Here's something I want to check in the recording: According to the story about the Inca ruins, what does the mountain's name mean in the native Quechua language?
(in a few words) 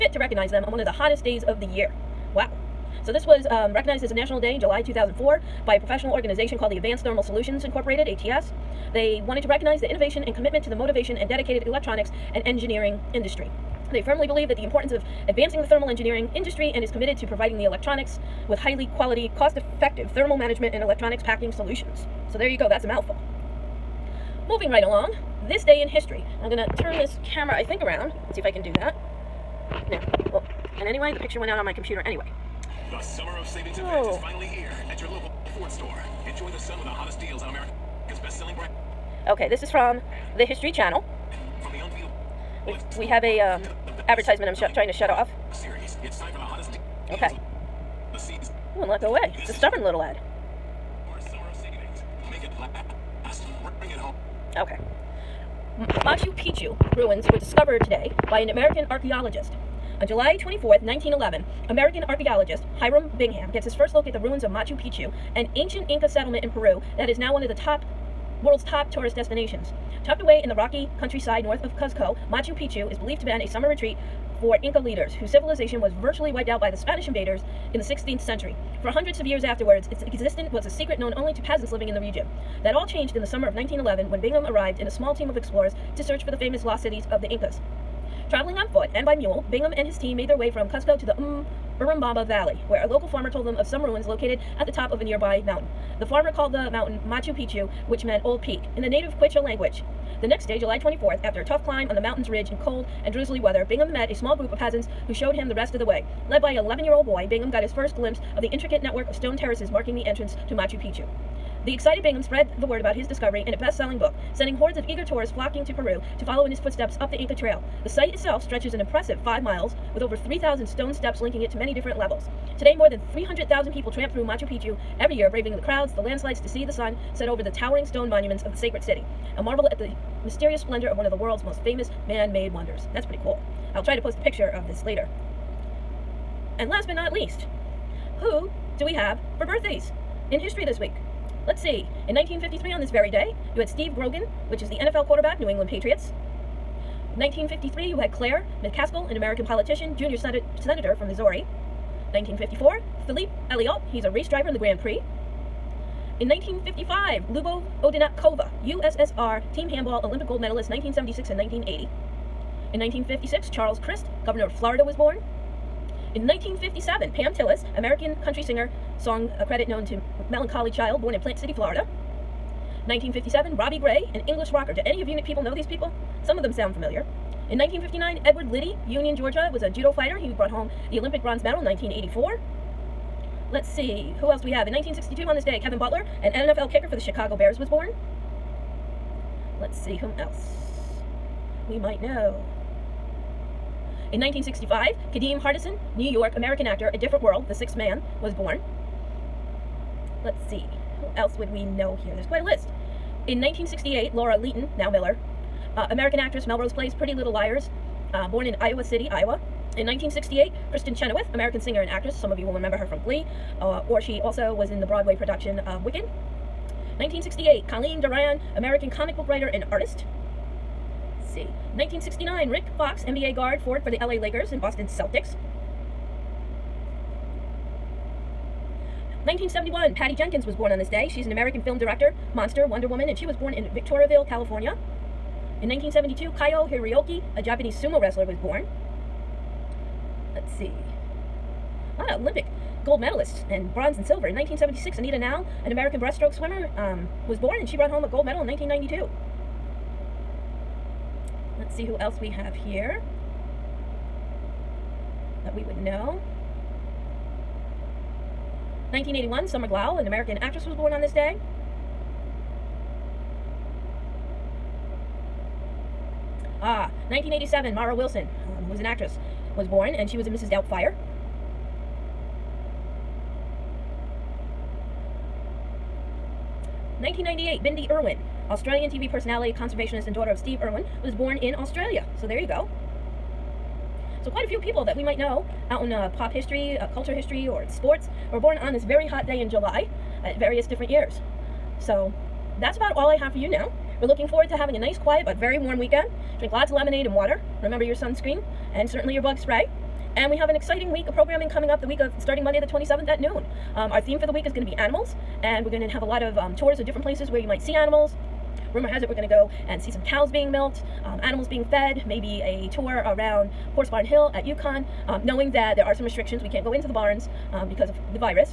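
Old Peak.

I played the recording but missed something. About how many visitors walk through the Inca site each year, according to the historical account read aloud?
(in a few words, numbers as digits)
300,000.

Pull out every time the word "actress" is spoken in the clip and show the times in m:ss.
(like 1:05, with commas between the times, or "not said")
3:26, 3:31, 4:20, 4:28.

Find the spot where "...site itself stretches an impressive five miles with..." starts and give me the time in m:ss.
1:57.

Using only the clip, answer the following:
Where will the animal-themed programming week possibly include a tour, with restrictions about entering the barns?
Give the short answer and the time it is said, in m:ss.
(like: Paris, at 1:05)
Horse Barn Hill at UConn, at 5:13.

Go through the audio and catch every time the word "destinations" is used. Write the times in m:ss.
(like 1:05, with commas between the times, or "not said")
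1:09.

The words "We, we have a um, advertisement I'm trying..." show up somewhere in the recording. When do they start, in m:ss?
0:42.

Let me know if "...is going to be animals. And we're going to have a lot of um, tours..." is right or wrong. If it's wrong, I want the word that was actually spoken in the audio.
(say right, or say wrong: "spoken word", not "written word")
right.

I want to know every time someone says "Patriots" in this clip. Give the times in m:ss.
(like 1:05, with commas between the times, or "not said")
2:25.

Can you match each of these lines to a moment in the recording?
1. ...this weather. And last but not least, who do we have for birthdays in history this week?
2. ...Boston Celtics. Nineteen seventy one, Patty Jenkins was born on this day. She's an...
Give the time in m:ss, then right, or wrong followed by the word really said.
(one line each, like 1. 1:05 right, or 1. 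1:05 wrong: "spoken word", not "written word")
1. 2:14 wrong: "later", not "weather"
2. 3:44 right.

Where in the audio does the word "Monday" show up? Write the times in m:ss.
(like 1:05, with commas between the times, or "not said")
5:02.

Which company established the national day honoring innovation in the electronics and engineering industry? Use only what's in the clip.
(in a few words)
Advanced Thermal Solutions Incorporated.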